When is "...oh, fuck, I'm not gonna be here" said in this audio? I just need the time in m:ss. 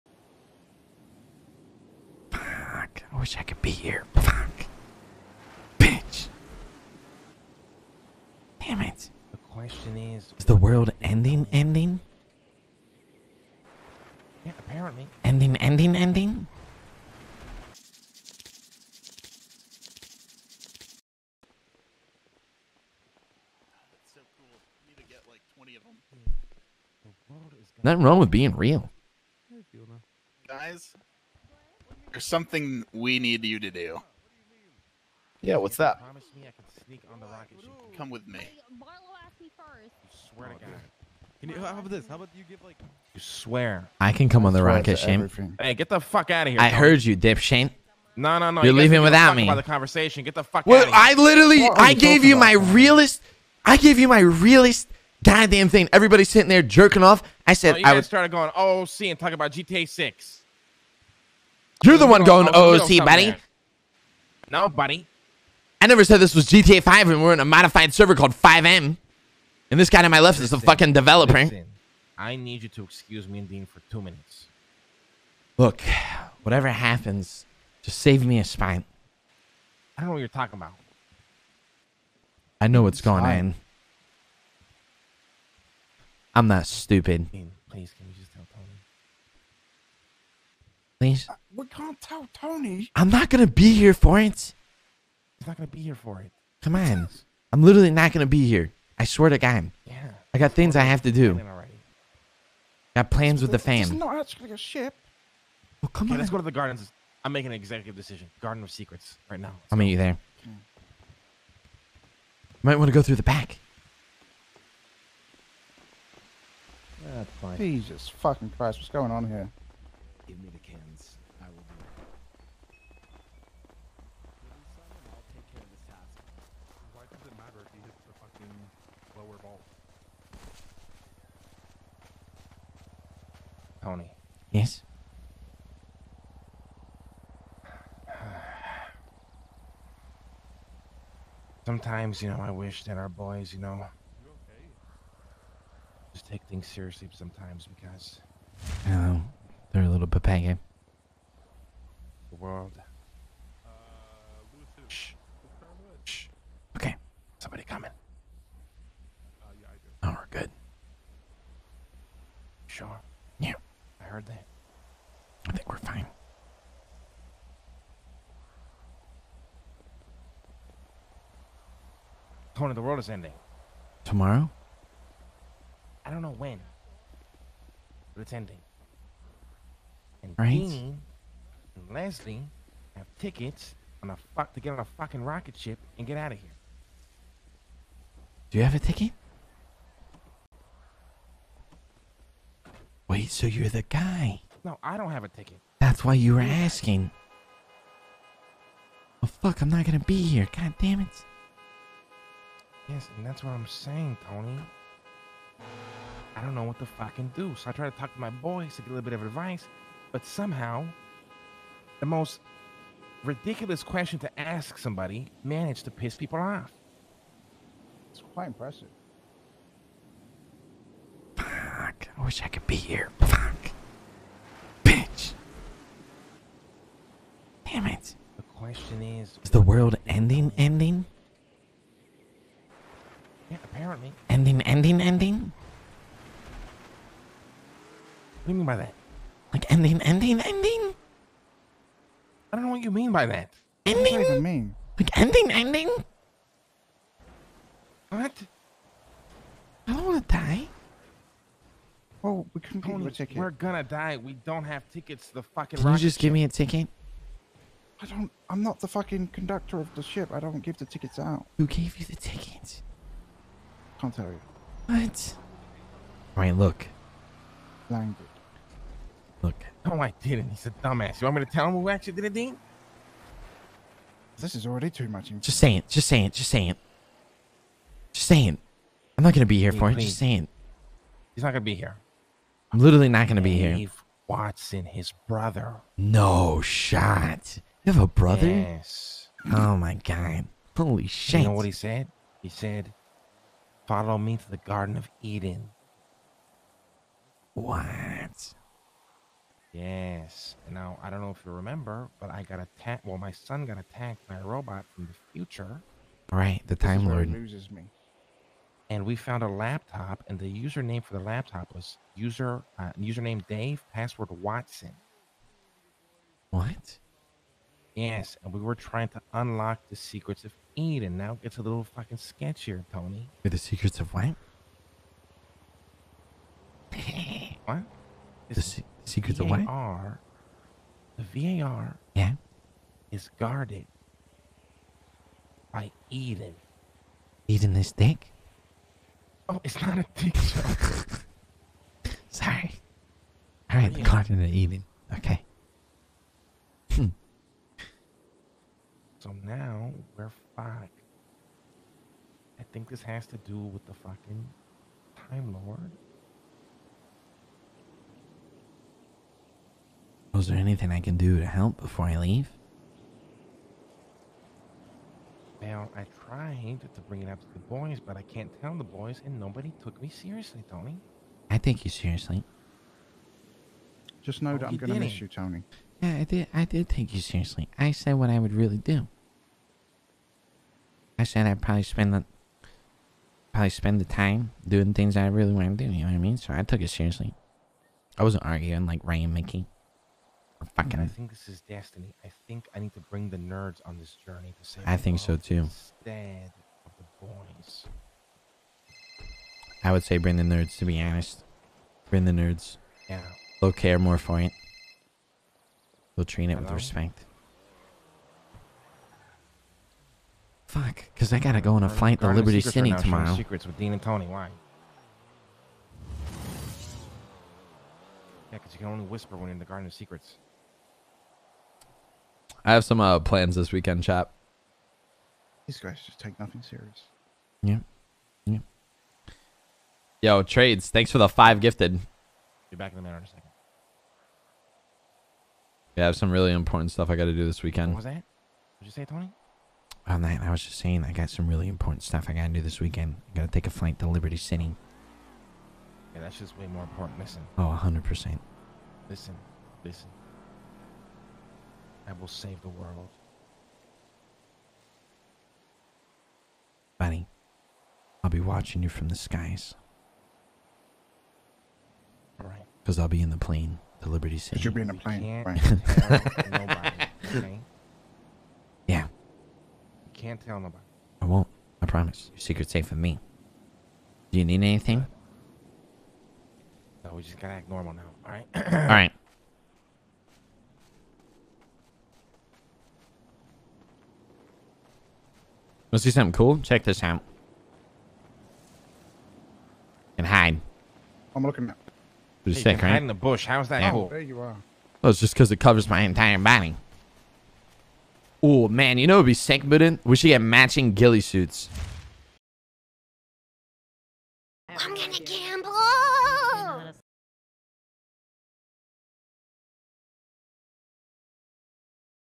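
3:19.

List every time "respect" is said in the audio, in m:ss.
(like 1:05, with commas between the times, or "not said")
6:46.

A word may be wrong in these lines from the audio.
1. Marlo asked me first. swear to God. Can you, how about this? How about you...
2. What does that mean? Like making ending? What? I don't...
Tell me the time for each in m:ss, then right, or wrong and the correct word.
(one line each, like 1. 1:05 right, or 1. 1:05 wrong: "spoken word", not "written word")
1. 0:38 right
2. 4:04 wrong: "ending", not "making".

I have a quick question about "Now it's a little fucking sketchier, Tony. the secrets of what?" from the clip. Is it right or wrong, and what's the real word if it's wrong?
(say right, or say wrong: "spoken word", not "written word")
right.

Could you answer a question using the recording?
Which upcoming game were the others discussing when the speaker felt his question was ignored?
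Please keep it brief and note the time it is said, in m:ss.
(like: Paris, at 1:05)
GTA Six, at 0:59.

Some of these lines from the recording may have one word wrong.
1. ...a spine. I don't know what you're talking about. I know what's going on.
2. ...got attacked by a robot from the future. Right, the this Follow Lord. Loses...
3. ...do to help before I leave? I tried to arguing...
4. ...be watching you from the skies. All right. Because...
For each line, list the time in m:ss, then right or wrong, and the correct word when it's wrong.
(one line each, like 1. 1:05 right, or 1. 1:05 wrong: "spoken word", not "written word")
1. 1:18 right
2. 5:03 wrong: "Time", not "Follow"
3. 6:01 wrong: "bring", not "arguing"
4. 7:38 right.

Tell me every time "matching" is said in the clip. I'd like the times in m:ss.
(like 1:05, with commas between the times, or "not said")
8:20.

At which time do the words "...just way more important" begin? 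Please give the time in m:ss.
7:26.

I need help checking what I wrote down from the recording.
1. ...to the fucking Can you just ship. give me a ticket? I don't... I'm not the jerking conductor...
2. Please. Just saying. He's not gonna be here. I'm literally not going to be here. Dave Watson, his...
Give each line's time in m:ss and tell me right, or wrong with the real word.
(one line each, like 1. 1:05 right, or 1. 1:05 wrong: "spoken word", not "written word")
1. 4:15 wrong: "fucking", not "jerking"
2. 4:39 right.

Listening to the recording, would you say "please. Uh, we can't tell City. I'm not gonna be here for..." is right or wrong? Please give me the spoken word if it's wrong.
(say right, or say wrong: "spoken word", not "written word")
wrong: "Tony", not "City".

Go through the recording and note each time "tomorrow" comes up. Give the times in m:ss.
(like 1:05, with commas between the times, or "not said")
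2:54, 6:52.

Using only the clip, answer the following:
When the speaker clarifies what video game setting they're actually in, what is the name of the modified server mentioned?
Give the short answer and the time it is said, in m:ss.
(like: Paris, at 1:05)
FiveM, at 1:08.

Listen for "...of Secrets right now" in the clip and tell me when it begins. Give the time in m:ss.
1:48.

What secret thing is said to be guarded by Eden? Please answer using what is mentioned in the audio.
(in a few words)
The VAR.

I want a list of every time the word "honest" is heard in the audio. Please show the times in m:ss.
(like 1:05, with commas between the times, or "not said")
6:41.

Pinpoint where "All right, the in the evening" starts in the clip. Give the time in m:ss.
5:43.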